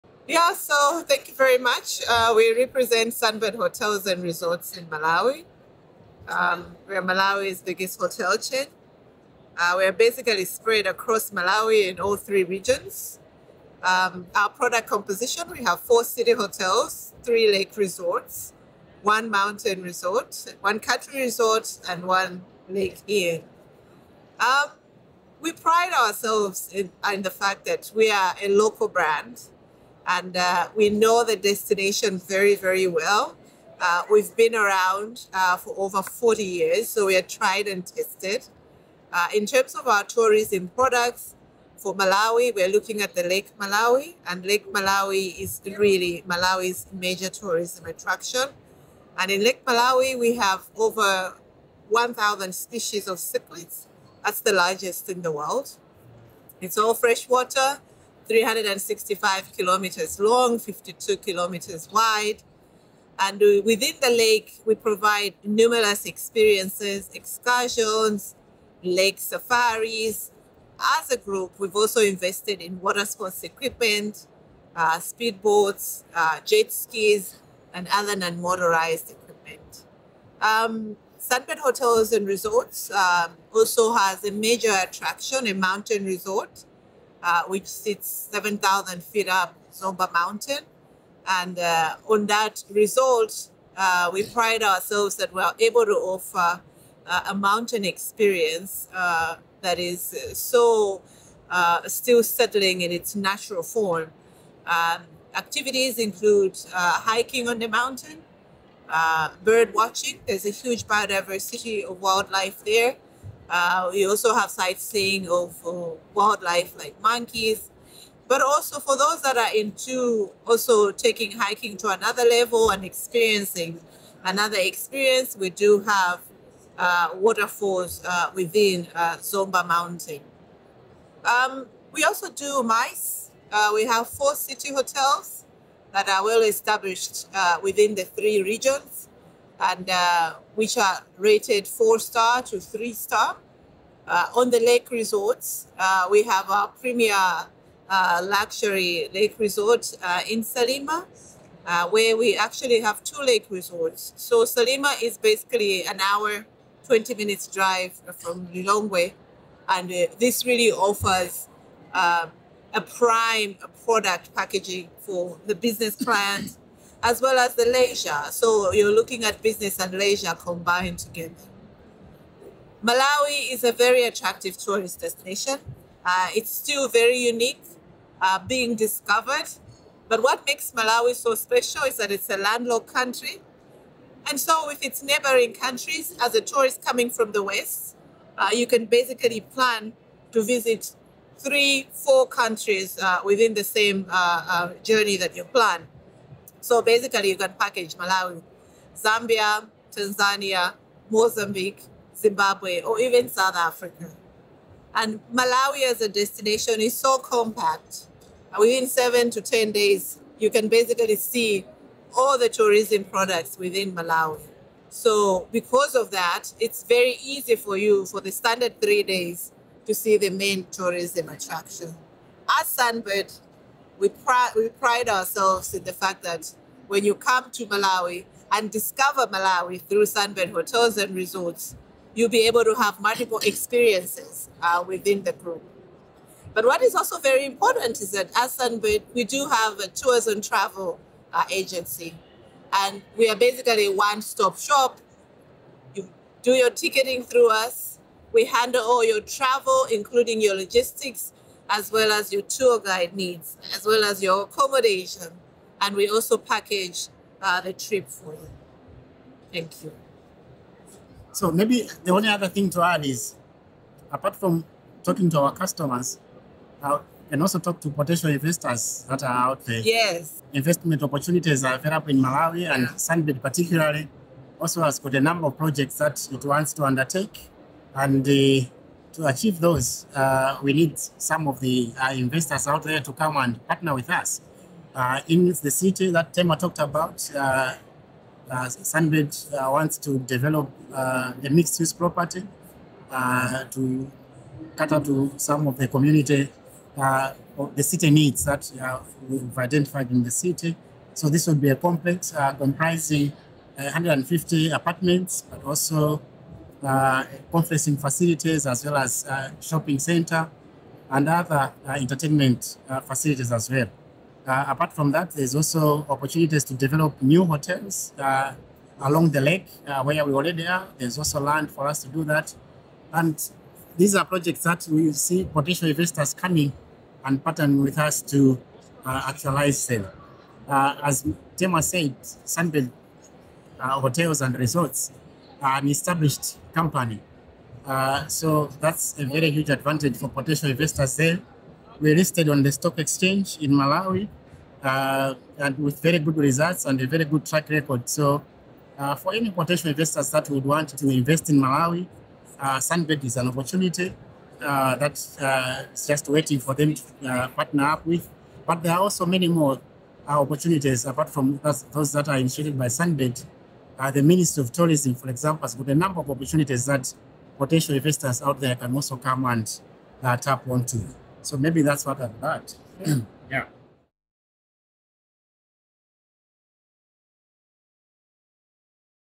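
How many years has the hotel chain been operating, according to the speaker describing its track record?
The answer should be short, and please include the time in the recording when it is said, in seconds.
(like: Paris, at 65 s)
over 40, at 35 s.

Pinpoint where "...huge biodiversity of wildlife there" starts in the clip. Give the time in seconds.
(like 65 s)
110 s.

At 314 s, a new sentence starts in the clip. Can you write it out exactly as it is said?
apart from that, there's also opportunities to develop new hotels along the lake where we already are.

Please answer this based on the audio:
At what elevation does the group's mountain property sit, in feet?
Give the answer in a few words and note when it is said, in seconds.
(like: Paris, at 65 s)
7,000 feet, at 88 s.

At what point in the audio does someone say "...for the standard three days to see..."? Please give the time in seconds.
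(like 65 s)
218 s.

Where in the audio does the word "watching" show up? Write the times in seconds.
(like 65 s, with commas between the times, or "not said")
109 s.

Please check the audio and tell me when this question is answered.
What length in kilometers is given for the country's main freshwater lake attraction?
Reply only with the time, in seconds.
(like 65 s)
58 s.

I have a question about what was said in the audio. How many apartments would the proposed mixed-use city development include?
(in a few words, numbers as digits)
150.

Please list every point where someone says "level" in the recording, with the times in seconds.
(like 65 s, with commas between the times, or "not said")
122 s.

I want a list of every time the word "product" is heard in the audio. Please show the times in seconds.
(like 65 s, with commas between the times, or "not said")
14 s, 40 s, 163 s, 213 s.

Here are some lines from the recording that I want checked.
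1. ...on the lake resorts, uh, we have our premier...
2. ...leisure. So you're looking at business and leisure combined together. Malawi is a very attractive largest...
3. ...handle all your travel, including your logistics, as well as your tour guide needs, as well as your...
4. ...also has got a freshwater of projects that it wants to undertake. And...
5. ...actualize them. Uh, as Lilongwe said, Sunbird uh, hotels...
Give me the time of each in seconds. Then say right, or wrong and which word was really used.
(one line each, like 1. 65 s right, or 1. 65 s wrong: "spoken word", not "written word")
1. 144 s right
2. 167 s wrong: "tourist", not "largest"
3. 248 s right
4. 274 s wrong: "number", not "freshwater"
5. 329 s wrong: "Tema", not "Lilongwe".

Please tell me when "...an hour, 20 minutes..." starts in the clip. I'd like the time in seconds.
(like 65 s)
155 s.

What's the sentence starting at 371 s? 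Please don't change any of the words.
So maybe that's what I've got.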